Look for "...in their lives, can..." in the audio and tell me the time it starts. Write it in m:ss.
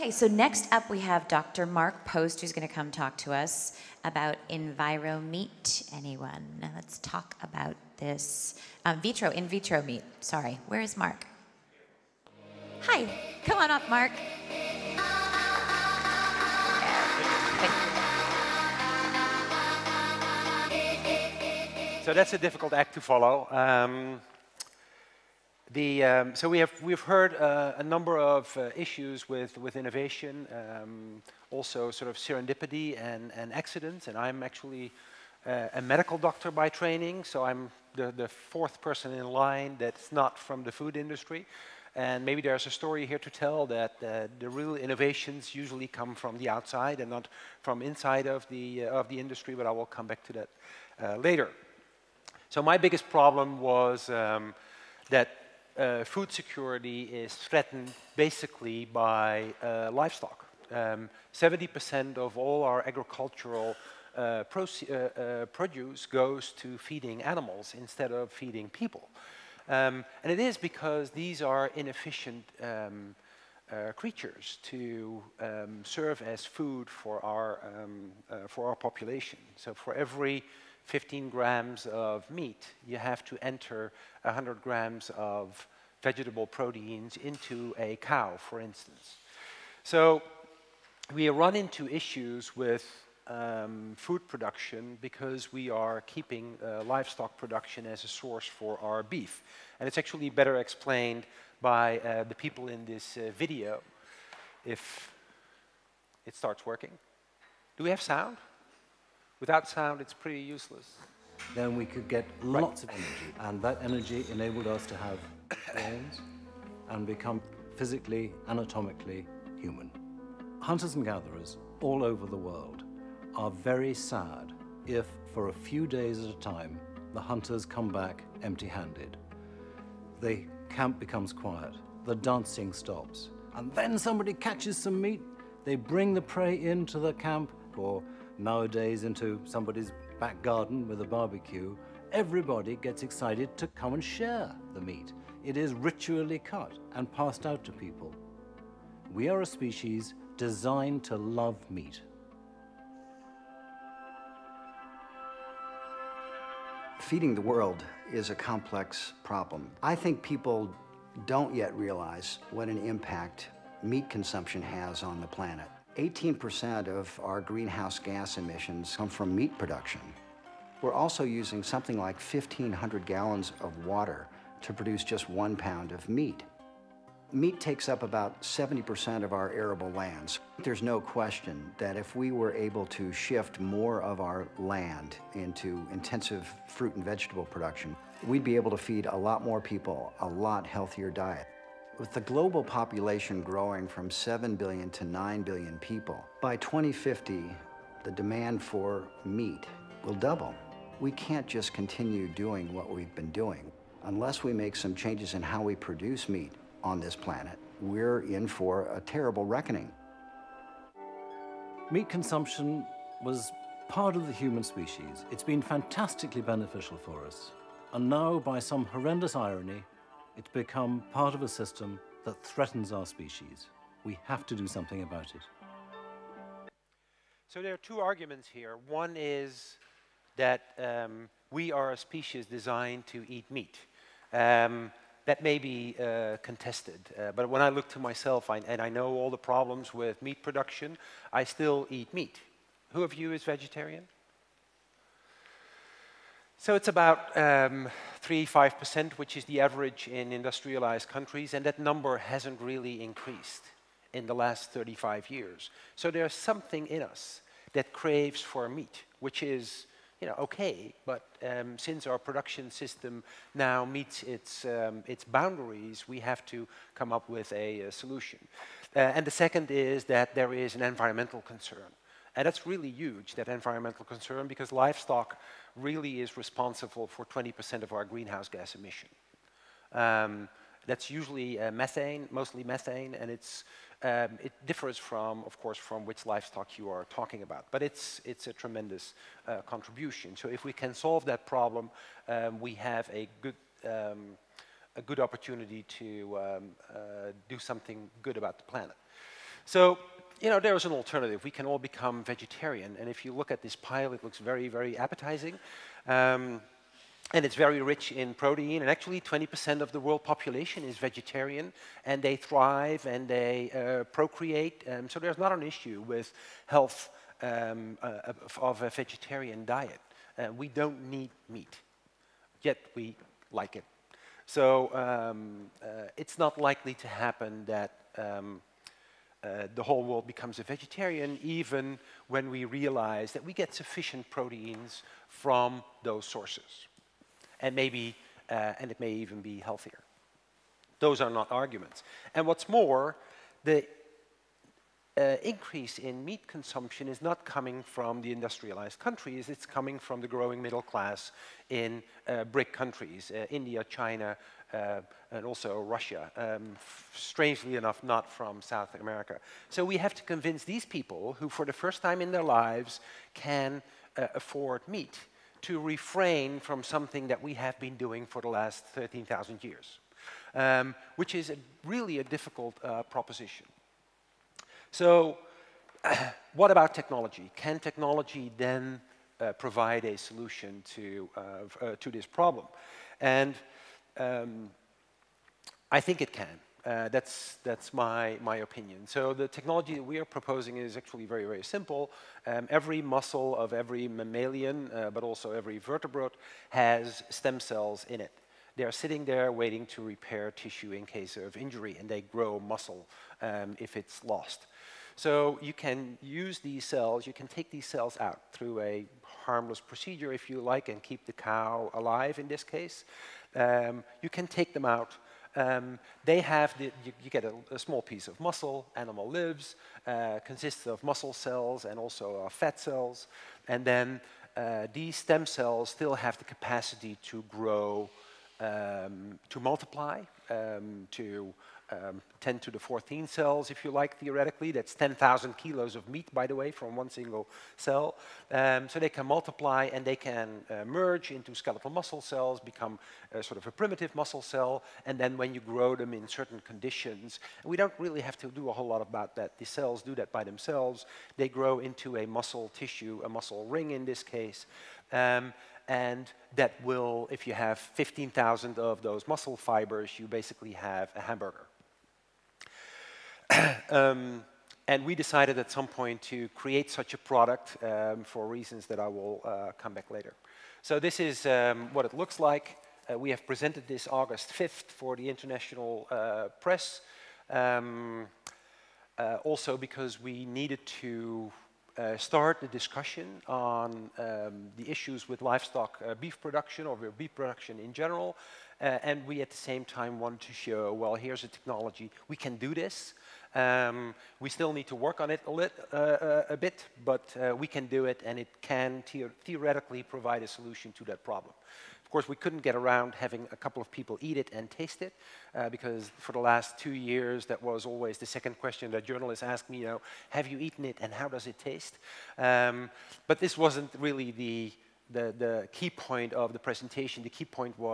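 6:02.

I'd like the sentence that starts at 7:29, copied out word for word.
The cells do that by themselves.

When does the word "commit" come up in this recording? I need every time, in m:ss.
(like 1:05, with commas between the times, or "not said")
not said.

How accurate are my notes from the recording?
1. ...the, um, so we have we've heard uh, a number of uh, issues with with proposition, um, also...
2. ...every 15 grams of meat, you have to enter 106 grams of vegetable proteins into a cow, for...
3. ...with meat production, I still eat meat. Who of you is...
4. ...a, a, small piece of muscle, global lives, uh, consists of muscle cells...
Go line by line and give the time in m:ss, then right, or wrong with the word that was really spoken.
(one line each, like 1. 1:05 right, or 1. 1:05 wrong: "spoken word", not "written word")
1. 0:25 wrong: "innovation", not "proposition"
2. 1:19 wrong: "100", not "106"
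3. 3:59 right
4. 6:57 wrong: "animal", not "global".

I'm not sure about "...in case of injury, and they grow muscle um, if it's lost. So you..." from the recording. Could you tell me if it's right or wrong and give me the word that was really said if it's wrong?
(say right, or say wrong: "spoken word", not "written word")
right.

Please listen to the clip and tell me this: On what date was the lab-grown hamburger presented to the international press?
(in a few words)
August 5th.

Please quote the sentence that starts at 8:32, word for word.
Um, but this wasn't really the, the, the, key point of the presentation.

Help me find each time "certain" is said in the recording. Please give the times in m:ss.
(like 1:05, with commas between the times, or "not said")
7:26.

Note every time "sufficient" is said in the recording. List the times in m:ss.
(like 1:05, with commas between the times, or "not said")
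5:33.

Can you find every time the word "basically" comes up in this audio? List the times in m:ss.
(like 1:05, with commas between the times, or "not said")
0:58, 7:40.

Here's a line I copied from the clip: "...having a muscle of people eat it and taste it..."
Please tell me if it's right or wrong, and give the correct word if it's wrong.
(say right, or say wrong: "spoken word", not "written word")
wrong: "couple", not "muscle".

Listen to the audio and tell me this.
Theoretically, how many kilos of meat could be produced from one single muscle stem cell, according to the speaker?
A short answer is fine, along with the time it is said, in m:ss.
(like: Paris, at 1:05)
10,000 kilos, at 7:14.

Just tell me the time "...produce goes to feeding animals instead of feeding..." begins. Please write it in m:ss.
1:05.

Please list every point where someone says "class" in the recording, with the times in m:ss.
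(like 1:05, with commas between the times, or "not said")
5:50.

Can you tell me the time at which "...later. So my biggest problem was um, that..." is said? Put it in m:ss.
0:51.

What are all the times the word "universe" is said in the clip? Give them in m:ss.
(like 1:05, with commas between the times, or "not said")
not said.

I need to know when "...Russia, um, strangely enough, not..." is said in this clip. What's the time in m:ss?
5:55.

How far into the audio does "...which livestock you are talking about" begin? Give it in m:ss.
4:46.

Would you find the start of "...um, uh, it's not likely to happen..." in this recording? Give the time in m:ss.
5:24.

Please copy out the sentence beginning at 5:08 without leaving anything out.
And actually, 20% of the world population is vegetarian.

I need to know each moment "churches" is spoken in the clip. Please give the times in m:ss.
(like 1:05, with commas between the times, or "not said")
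not said.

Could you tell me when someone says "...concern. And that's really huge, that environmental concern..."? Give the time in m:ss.
4:31.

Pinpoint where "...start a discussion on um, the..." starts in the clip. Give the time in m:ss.
8:02.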